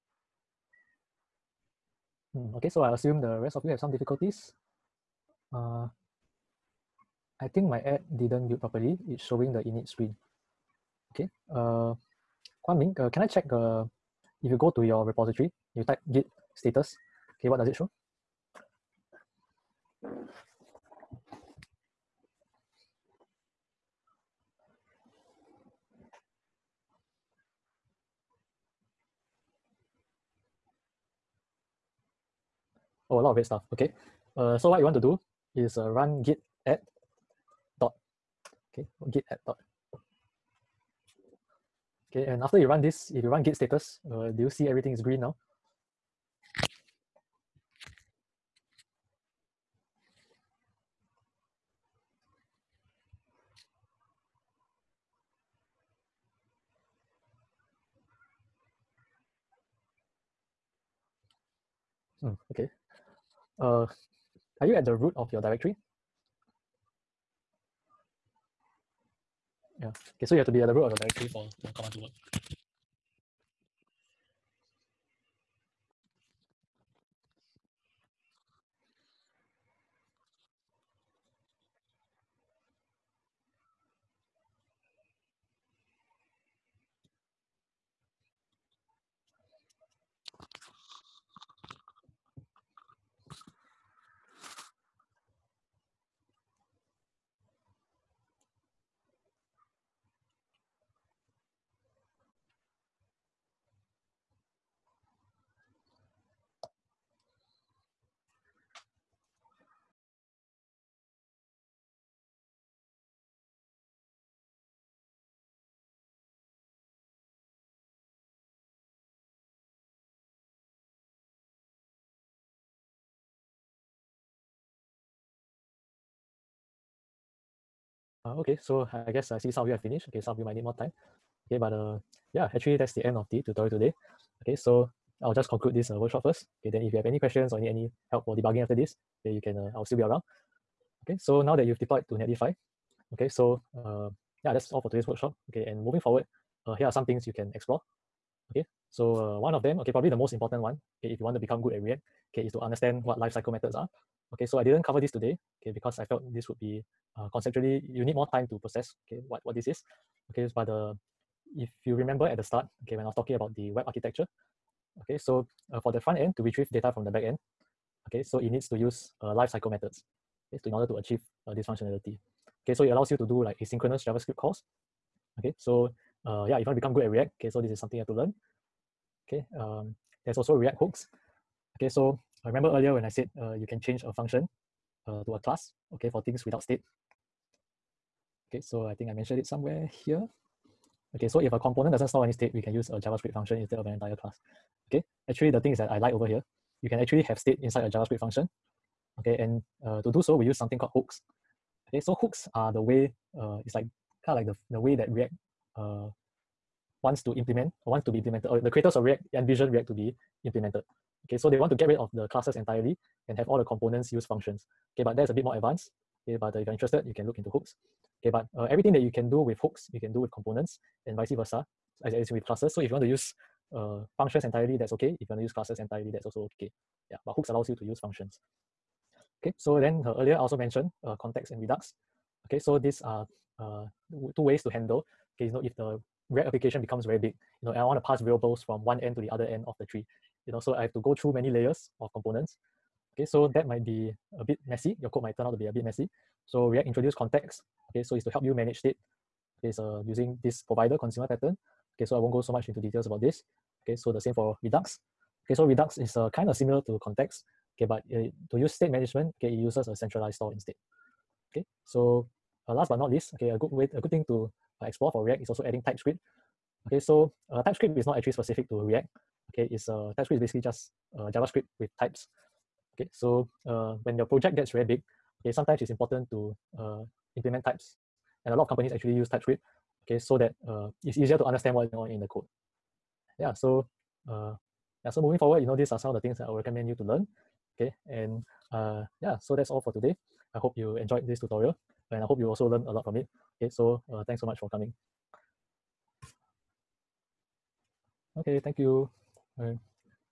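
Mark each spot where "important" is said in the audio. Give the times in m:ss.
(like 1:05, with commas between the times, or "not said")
2:30, 4:35.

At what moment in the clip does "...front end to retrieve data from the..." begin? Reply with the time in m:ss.
2:45.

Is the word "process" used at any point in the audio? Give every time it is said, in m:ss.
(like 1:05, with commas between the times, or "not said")
2:38.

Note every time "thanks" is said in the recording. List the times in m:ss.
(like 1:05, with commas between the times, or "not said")
4:54, 4:58.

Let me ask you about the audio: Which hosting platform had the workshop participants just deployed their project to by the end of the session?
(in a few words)
Netlify.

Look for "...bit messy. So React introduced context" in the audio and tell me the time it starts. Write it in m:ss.
4:05.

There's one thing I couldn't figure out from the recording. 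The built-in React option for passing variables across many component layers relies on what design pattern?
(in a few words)
provider consumer pattern.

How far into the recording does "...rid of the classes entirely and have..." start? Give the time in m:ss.
3:31.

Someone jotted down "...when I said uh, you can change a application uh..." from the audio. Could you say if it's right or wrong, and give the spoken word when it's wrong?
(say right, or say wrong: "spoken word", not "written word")
wrong: "function", not "application".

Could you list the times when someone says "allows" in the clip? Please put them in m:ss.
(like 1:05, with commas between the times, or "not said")
2:52, 3:47.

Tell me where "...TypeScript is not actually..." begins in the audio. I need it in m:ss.
4:27.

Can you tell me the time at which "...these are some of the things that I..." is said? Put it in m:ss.
4:45.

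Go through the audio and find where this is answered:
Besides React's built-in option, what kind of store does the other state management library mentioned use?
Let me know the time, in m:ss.
4:19.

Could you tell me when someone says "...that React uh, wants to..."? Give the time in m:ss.
3:24.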